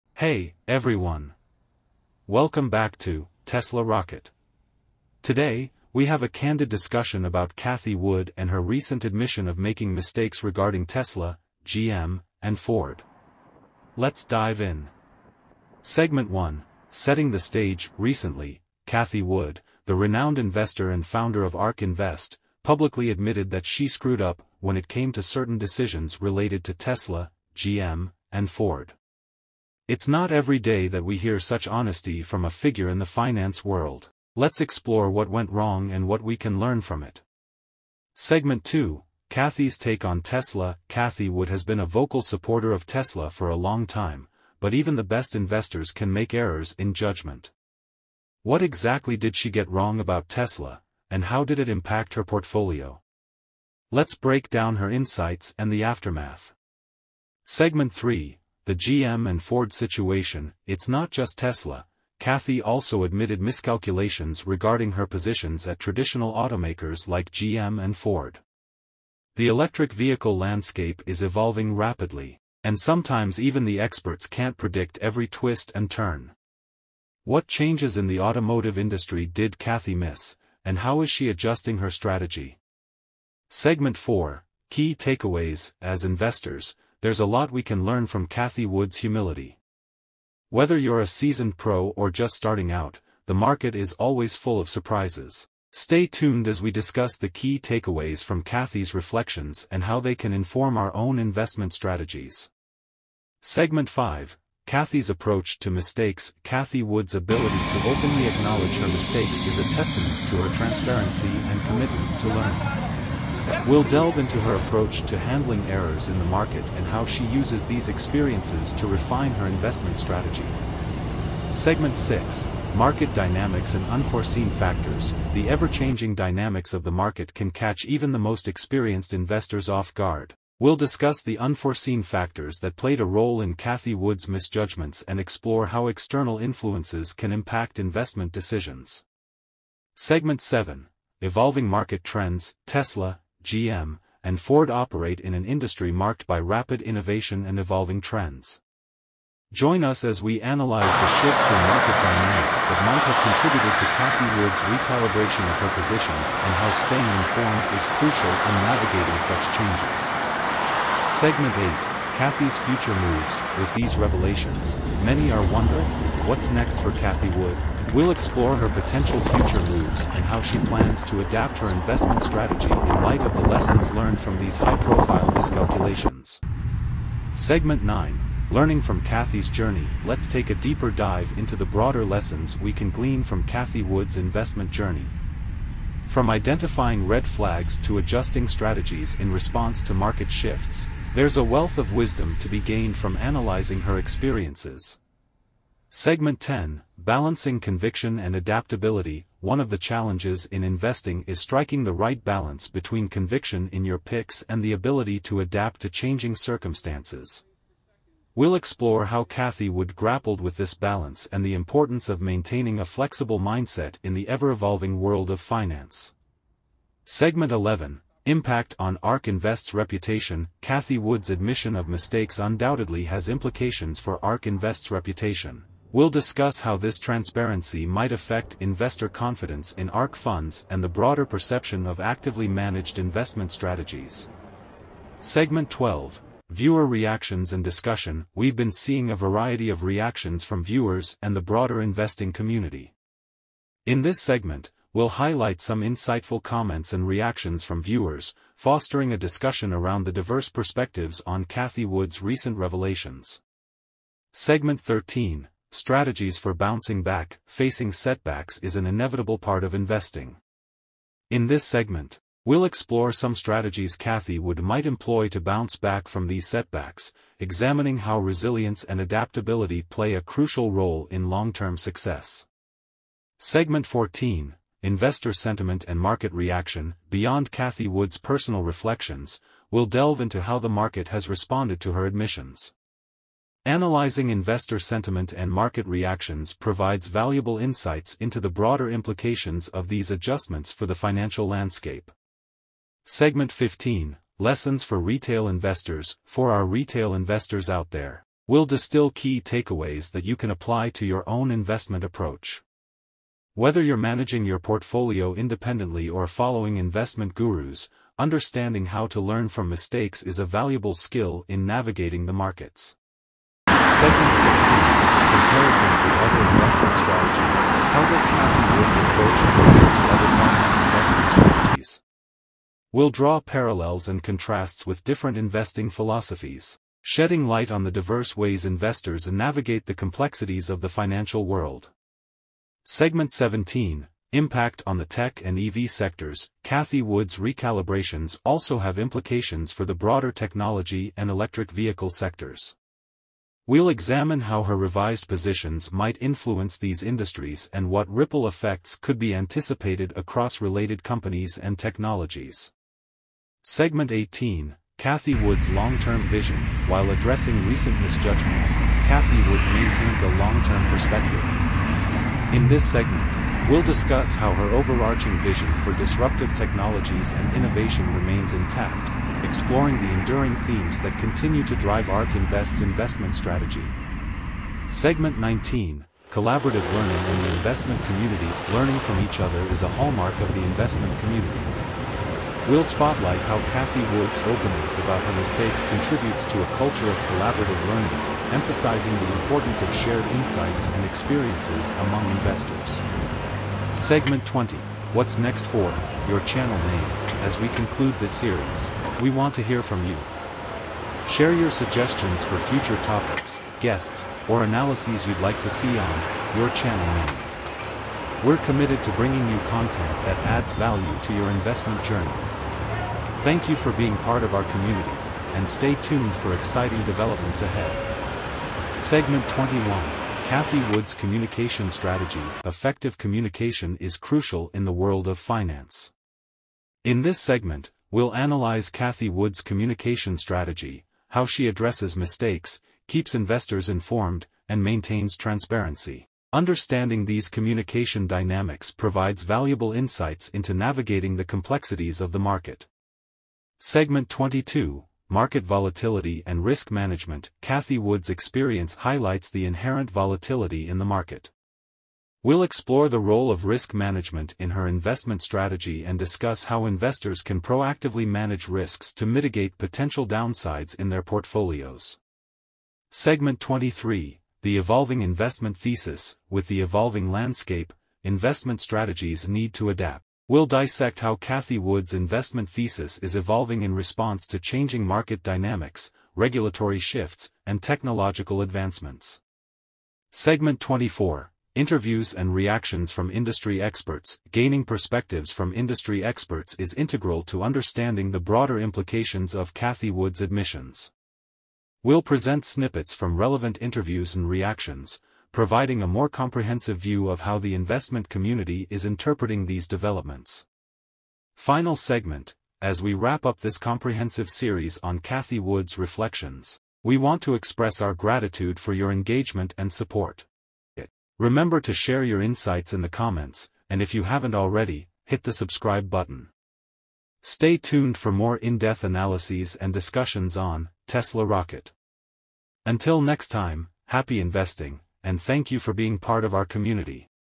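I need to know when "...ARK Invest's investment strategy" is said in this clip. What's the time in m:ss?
6:12.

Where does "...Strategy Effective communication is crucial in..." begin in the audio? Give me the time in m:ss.
7:01.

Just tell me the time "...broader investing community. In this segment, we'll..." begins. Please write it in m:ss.
4:01.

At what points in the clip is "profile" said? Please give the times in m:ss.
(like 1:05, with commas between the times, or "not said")
2:54.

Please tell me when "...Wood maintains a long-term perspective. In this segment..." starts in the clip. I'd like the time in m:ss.
5:59.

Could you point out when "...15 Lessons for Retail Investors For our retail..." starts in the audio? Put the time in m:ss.
4:53.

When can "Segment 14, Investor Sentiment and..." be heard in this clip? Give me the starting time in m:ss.
4:33.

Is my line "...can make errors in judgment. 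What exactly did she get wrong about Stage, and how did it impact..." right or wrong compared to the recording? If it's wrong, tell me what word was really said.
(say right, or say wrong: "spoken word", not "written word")
wrong: "Tesla", not "Stage".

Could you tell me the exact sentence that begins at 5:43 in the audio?
We'll examine how her revised positions might influence these industries and what ripple effects could be anticipated across related companies and technologies.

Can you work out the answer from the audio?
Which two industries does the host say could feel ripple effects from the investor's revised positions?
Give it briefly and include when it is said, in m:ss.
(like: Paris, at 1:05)
Tech and EV, at 5:35.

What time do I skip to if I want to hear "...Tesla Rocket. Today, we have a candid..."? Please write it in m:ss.
0:03.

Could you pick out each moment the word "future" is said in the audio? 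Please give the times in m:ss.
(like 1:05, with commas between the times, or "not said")
2:42, 2:49, 6:42.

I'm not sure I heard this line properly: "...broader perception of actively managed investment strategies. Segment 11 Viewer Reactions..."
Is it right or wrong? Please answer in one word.
wrong.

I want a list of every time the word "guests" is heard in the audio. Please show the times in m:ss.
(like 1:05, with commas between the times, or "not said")
6:43.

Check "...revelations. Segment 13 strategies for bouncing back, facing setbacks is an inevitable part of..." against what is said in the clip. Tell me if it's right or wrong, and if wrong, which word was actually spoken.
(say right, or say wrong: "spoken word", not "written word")
right.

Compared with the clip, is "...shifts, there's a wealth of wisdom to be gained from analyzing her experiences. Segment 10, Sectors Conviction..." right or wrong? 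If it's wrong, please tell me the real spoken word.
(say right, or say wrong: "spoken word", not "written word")
wrong: "Balancing", not "Sectors".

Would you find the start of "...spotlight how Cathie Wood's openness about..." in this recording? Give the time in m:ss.
6:22.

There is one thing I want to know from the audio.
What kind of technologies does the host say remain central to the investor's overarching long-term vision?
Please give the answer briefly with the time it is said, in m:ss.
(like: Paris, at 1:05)
Disruptive technologies, at 6:05.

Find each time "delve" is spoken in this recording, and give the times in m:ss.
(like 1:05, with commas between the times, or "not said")
1:53, 4:39.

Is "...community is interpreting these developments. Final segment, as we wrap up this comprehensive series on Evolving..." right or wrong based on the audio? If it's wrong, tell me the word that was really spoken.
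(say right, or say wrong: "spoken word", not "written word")
wrong: "Cathie", not "Evolving".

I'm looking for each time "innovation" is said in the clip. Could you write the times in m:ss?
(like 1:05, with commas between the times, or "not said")
2:26, 6:07.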